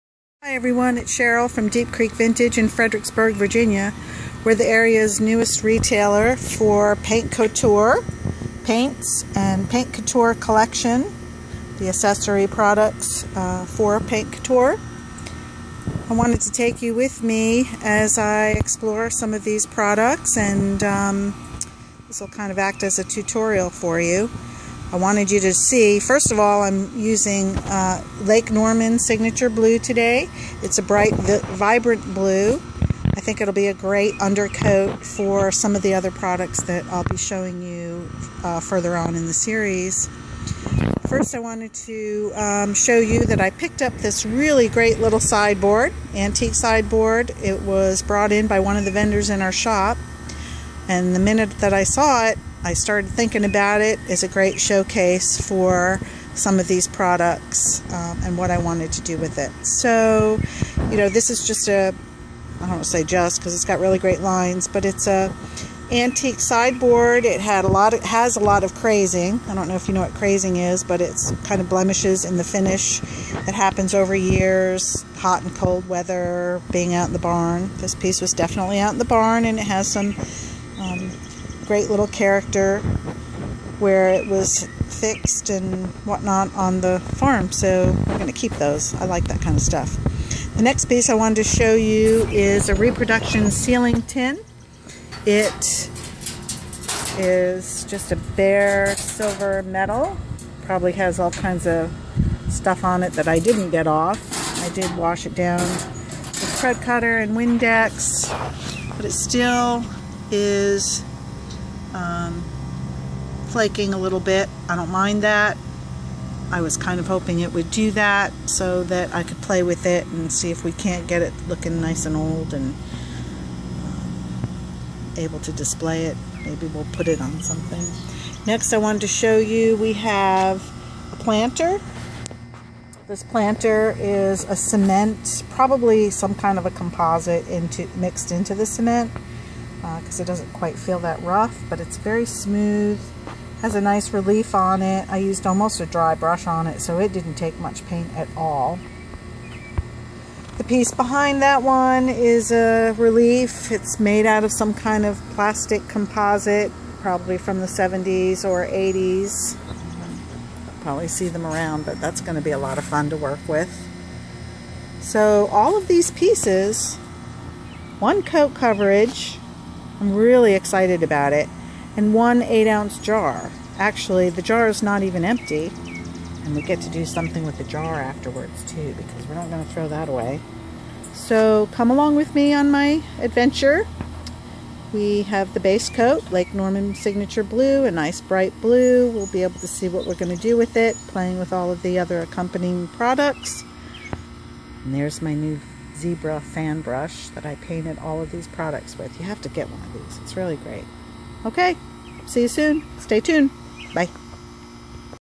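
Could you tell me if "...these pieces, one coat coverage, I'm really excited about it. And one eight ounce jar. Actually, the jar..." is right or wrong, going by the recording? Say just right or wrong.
right.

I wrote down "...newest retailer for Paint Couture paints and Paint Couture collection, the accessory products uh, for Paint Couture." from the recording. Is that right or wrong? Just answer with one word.
right.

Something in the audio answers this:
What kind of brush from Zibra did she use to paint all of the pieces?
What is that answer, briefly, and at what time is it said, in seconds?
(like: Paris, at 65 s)
fan brush, at 196 s.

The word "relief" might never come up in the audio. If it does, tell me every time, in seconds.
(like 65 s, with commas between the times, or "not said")
144 s, 152 s.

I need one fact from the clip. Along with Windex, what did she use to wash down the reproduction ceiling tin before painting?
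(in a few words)
thread cutter.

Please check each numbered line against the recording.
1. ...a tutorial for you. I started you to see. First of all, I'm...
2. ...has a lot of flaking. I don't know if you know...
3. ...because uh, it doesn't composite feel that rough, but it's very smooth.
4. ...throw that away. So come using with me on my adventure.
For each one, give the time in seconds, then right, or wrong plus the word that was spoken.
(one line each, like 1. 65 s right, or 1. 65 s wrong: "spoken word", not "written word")
1. 22 s wrong: "wanted", not "started"
2. 68 s wrong: "crazing", not "flaking"
3. 139 s wrong: "quite", not "composite"
4. 179 s wrong: "along", not "using".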